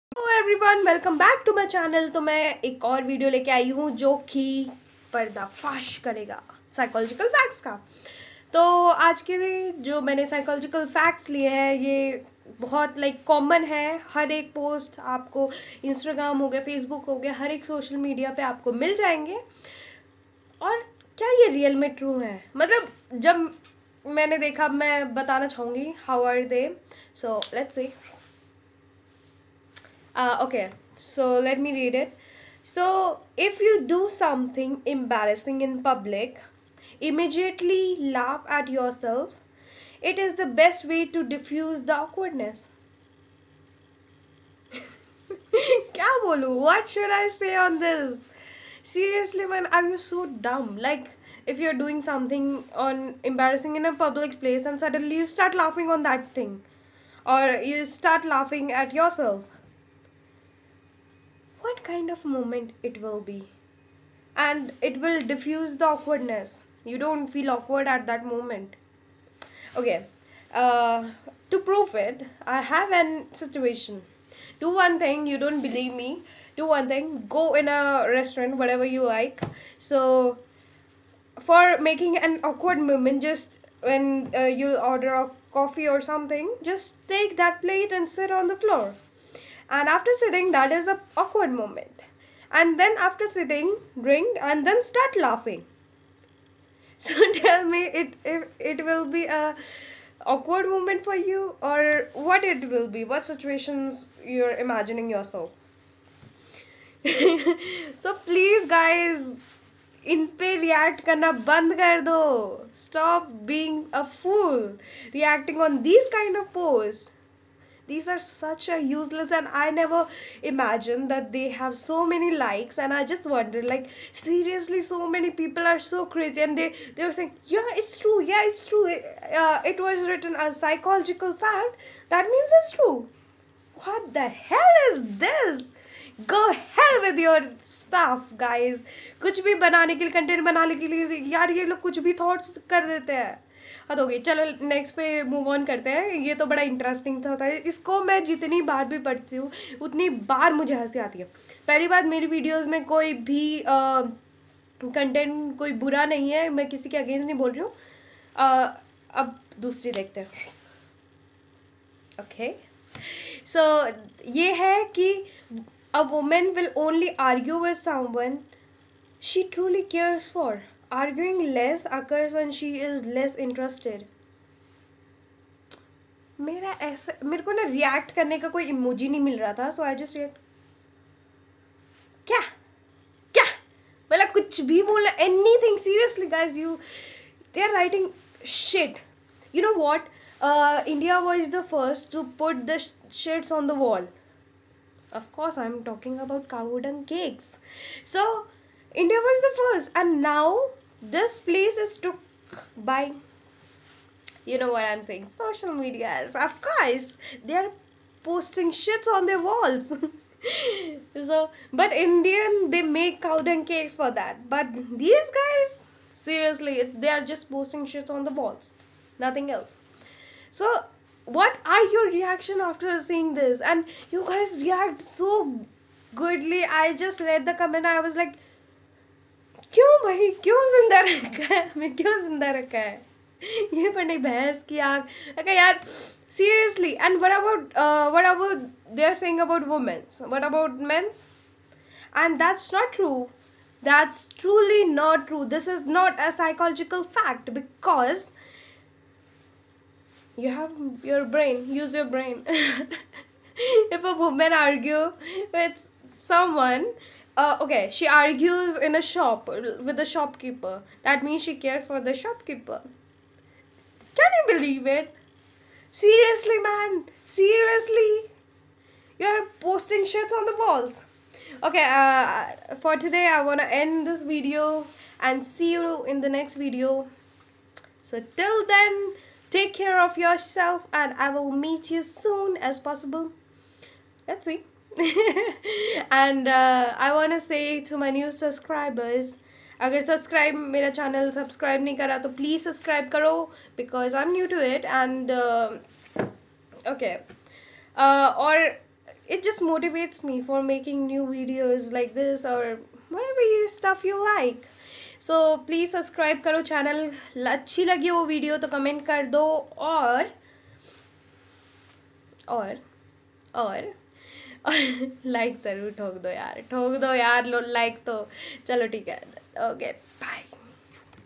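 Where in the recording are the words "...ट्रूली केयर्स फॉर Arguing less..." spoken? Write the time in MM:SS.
02:49.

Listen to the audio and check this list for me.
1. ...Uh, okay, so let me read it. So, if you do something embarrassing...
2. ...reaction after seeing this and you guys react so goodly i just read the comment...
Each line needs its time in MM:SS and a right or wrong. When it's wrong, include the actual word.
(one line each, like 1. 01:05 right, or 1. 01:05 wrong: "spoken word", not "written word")
1. 00:30 right
2. 03:42 right.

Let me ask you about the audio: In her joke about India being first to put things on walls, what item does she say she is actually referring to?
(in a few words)
cow dung cakes.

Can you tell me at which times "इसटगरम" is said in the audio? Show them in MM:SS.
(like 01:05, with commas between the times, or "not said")
00:15.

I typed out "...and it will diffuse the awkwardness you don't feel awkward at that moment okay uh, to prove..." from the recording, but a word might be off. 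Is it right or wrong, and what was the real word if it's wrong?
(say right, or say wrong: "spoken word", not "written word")
right.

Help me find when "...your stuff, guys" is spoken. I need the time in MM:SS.
02:17.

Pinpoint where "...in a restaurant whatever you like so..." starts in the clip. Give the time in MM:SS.
01:17.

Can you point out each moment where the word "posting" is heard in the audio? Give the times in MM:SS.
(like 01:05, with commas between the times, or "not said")
03:28, 03:37, 04:29.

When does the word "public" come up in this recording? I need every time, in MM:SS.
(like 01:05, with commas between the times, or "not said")
00:35, 00:53.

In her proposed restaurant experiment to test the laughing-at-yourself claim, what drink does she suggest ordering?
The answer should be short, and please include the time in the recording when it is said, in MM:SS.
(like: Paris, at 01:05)
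coffee, at 01:25.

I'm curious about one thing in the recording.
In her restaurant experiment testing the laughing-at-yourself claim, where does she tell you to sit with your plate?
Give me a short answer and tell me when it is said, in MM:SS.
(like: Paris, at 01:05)
the floor, at 01:28.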